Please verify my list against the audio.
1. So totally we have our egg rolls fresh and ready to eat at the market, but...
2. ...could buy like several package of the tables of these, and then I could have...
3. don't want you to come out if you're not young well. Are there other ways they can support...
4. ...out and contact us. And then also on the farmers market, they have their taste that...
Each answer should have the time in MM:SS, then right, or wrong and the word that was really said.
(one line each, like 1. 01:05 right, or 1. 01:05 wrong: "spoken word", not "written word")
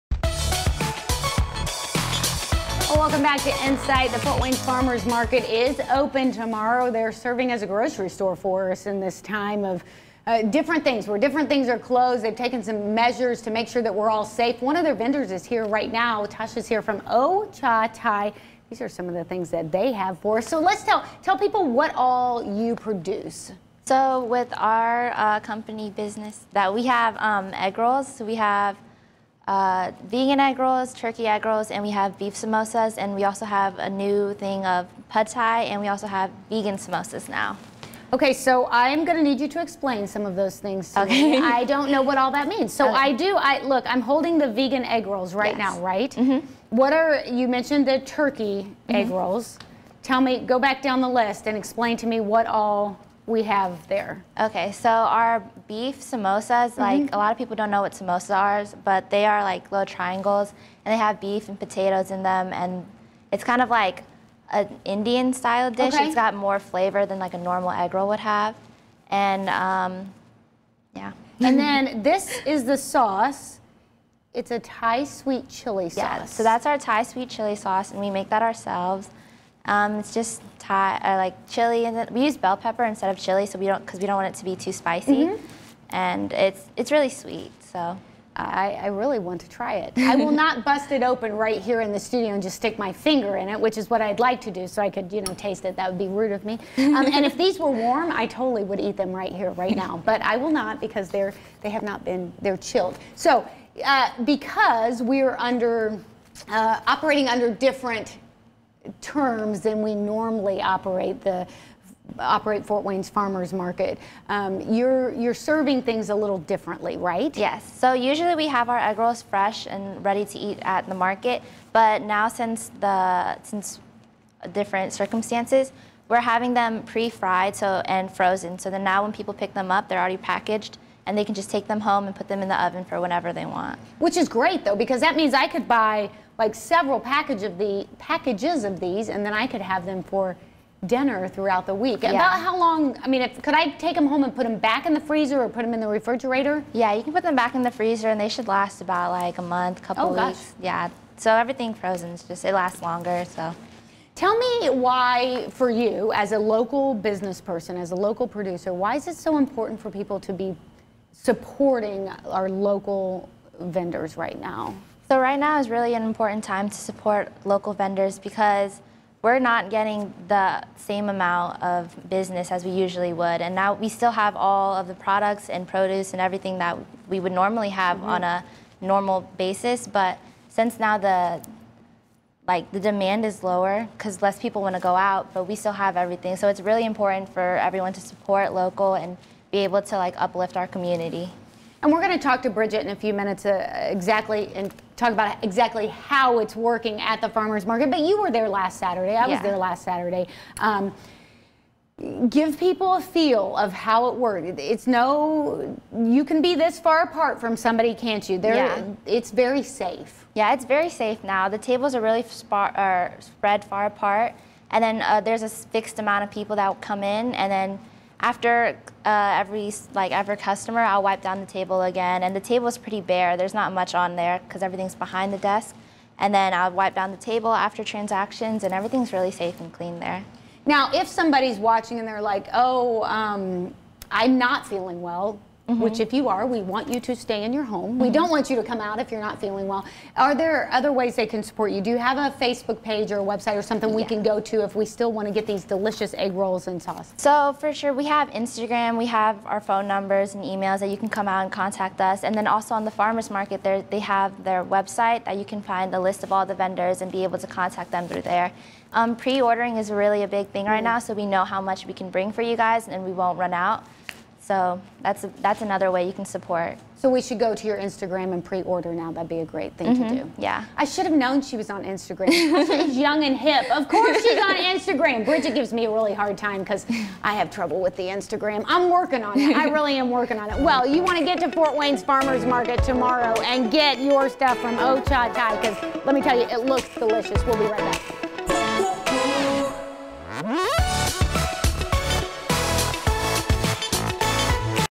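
1. 01:57 wrong: "usually", not "totally"
2. 02:15 wrong: "packages", not "tables"
3. 03:58 wrong: "feeling", not "young"
4. 04:11 wrong: "website", not "taste".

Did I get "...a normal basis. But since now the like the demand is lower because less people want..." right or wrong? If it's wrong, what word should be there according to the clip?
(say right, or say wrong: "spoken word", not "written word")
right.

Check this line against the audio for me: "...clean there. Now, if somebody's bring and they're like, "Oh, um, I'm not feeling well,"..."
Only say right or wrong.
wrong.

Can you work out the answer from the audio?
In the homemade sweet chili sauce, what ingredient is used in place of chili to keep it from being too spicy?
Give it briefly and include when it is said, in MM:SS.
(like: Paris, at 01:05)
Bell pepper, at 01:22.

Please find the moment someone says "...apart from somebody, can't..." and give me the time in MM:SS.
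03:27.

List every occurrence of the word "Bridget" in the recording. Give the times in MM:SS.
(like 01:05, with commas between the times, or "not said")
03:12, 04:35.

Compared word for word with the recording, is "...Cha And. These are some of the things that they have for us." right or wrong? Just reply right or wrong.
wrong.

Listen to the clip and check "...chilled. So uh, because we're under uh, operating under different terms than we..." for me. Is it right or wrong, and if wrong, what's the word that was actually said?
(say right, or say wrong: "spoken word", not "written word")
right.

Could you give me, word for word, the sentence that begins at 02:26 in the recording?
Yeah, you can put them back in the freezer and they should last about like a month, couple oh, weeks.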